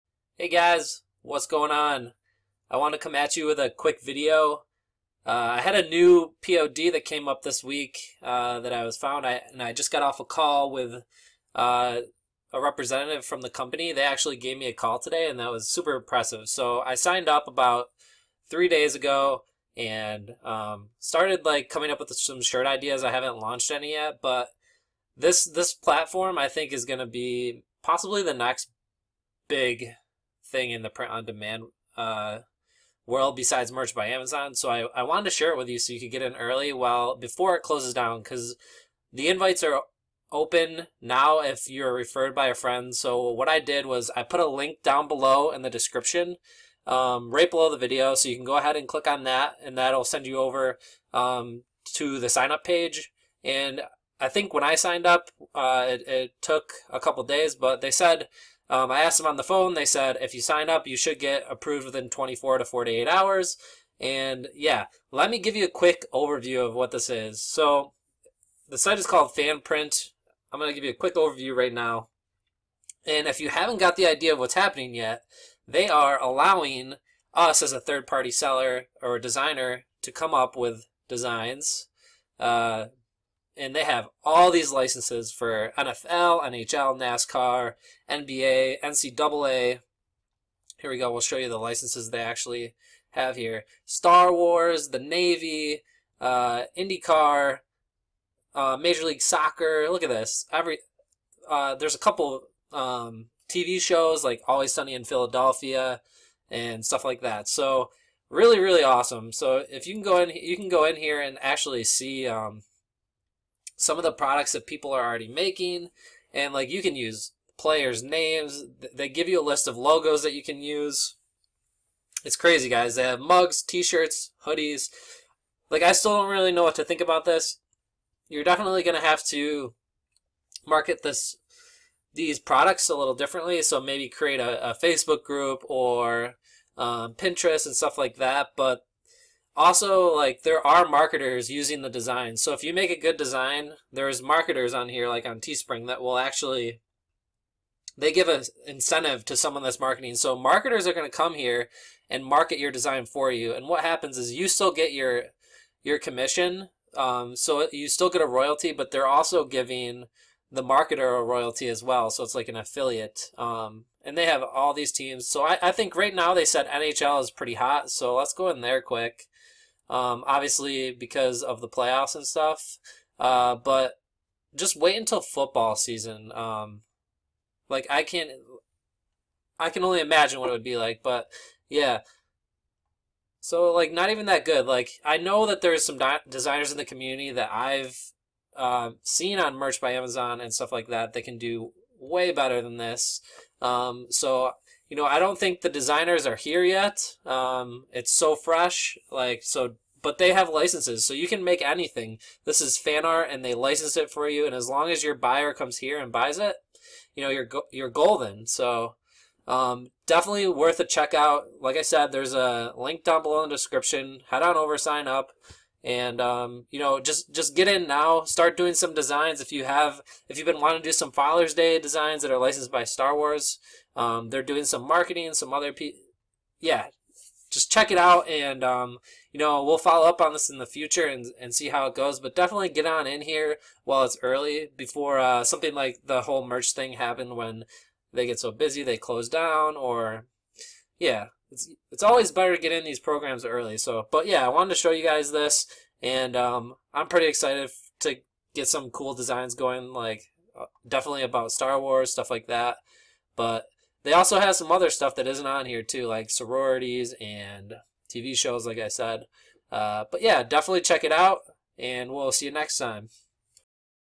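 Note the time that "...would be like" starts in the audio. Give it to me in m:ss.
3:00.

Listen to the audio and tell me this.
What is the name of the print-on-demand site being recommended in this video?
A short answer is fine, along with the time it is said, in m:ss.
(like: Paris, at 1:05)
Fanprint, at 1:09.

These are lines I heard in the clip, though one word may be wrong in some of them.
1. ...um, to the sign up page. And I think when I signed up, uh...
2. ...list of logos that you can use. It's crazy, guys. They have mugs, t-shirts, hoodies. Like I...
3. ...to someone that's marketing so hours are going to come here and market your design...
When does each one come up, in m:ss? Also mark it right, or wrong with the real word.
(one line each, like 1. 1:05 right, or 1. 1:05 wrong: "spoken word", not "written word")
1. 0:51 right
2. 1:59 right
3. 2:29 wrong: "marketers", not "hours".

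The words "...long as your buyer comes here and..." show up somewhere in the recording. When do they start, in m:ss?
3:24.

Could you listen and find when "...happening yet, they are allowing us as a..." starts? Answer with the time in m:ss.
1:14.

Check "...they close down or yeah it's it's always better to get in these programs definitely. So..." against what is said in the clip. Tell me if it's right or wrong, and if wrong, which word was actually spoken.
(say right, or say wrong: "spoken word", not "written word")
wrong: "early", not "definitely".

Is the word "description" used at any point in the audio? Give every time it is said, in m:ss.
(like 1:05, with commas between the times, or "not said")
0:45, 3:33.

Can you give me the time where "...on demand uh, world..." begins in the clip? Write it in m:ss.
0:31.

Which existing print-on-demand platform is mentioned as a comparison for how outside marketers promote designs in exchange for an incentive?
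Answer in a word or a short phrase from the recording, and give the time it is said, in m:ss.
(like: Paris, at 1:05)
Teespring, at 2:25.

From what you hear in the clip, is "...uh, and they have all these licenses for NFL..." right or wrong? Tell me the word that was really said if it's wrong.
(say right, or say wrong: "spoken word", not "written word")
right.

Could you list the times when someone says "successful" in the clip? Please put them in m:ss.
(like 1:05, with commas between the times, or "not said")
not said.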